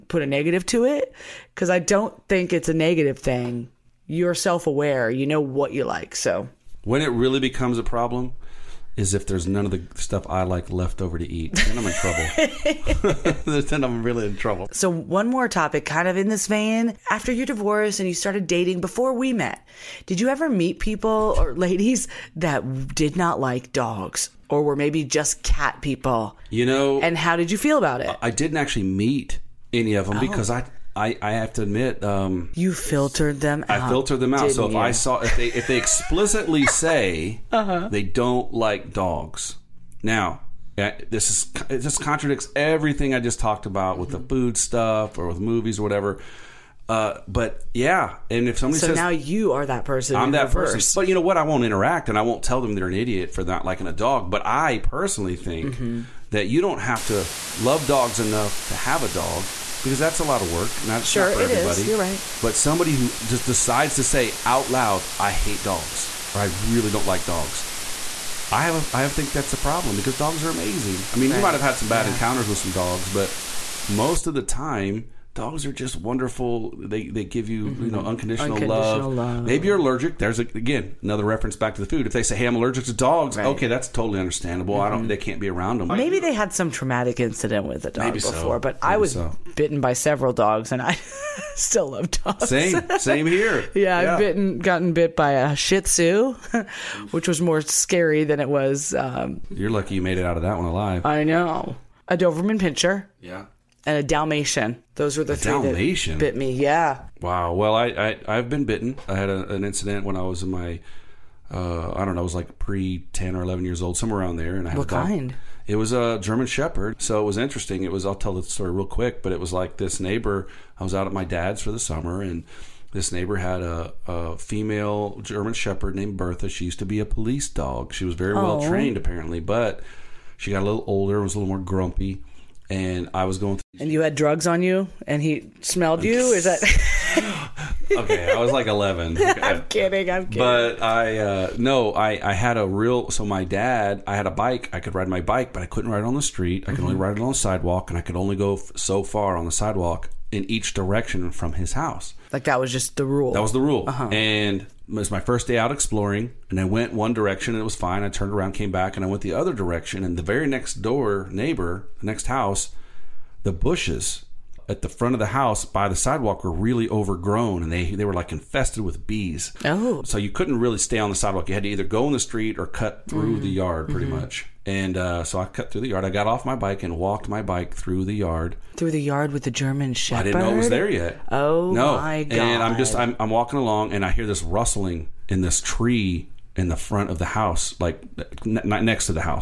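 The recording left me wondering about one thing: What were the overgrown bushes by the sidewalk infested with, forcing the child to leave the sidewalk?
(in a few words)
bees.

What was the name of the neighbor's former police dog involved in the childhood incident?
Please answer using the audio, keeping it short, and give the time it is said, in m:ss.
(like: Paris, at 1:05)
Bertha, at 2:06.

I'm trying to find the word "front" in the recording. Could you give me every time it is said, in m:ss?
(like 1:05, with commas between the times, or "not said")
2:44, 3:06.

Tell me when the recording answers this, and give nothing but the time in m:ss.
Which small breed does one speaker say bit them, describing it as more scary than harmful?
1:35.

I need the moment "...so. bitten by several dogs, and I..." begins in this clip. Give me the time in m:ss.
1:29.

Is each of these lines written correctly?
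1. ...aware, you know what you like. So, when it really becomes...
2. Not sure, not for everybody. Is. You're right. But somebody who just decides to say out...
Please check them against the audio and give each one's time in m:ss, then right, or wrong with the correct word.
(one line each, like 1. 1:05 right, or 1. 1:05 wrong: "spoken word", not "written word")
1. 0:04 right
2. 1:00 right.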